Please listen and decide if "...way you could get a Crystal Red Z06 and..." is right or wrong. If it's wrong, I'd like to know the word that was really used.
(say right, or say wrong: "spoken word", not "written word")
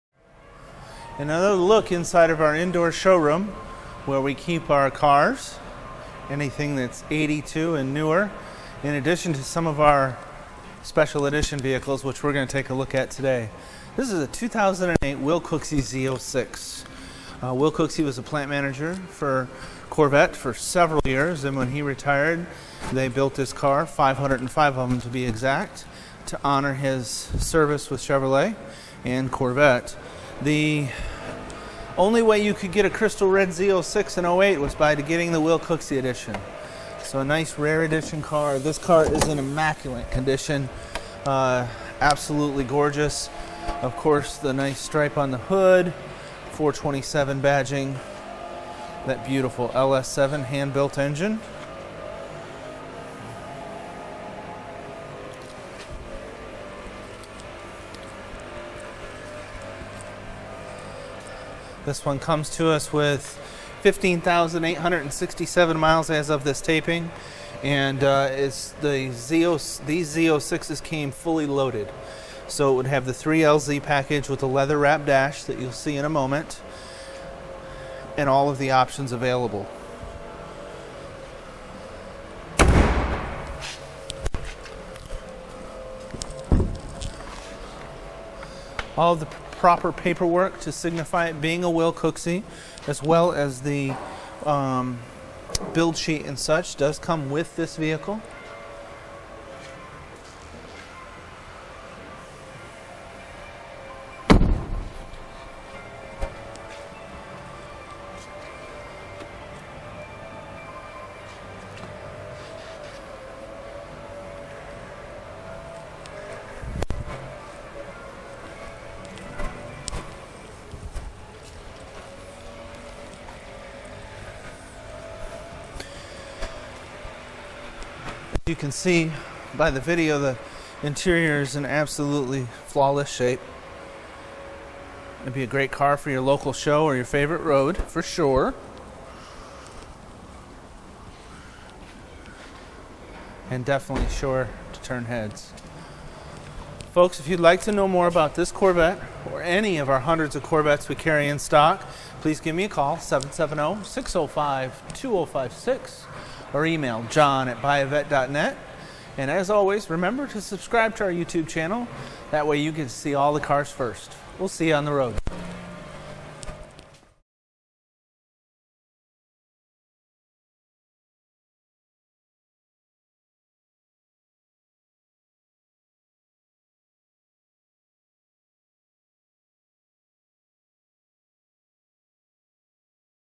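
right.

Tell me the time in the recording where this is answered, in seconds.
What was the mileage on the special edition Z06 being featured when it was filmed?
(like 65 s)
63 s.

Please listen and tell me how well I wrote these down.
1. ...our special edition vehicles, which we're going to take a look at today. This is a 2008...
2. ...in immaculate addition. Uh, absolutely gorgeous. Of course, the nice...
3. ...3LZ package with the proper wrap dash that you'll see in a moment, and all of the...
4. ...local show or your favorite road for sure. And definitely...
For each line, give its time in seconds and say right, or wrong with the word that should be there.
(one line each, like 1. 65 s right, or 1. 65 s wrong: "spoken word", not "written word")
1. 9 s right
2. 39 s wrong: "condition", not "addition"
3. 73 s wrong: "leather", not "proper"
4. 136 s right.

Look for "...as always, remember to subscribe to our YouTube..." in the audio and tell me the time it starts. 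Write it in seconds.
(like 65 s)
159 s.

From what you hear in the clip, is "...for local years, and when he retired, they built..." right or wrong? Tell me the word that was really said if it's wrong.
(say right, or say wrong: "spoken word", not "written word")
wrong: "several", not "local".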